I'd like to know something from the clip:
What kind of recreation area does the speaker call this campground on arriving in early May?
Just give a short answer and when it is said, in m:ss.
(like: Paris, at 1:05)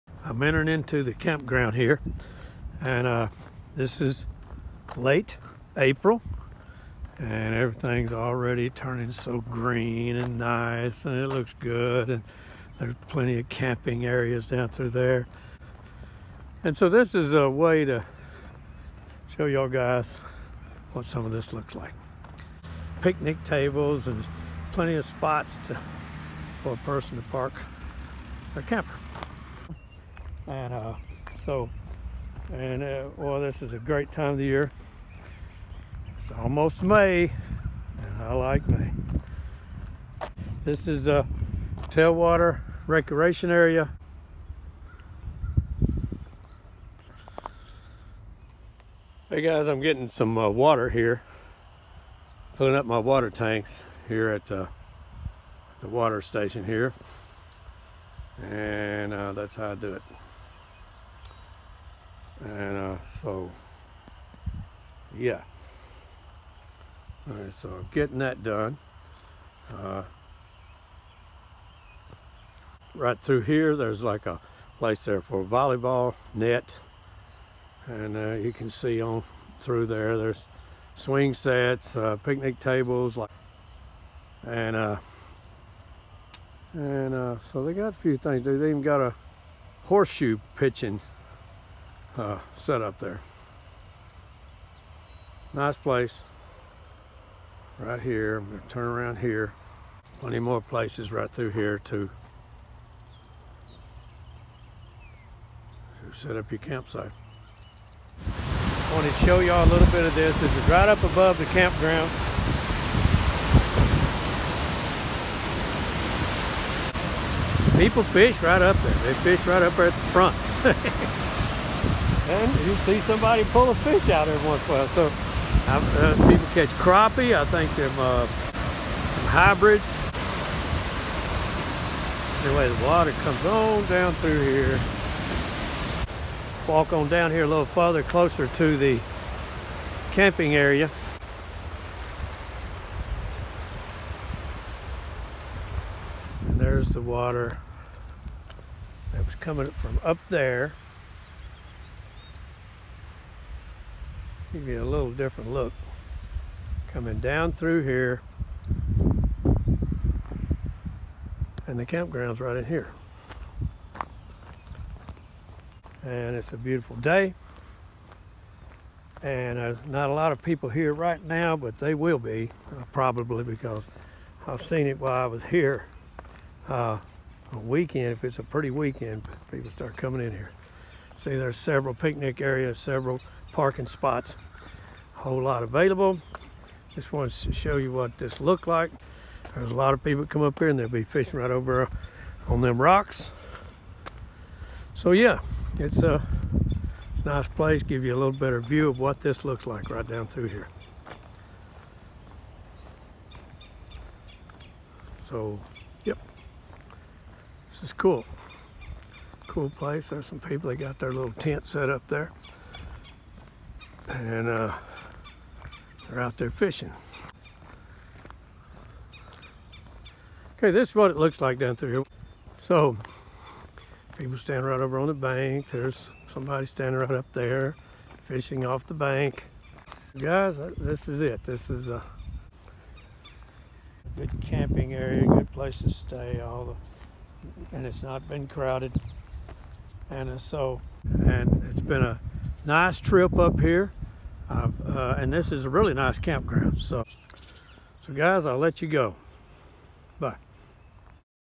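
tailwater recreation area, at 0:41.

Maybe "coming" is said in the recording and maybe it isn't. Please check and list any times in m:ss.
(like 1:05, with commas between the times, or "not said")
2:29, 2:36, 2:59.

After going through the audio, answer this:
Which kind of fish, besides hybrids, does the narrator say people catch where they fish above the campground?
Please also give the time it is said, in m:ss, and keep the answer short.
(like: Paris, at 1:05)
crappie, at 2:06.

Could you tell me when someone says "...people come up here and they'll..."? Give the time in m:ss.
3:10.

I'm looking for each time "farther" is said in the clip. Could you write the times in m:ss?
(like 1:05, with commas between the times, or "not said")
2:17.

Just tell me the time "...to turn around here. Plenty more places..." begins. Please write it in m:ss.
1:38.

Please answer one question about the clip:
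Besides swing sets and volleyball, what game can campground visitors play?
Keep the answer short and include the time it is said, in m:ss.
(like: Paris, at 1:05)
horseshoe pitching, at 1:29.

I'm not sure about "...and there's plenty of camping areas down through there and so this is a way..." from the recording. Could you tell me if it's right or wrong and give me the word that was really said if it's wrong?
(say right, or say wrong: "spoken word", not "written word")
right.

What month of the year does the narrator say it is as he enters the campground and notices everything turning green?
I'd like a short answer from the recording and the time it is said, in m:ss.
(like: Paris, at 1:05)
April, at 0:05.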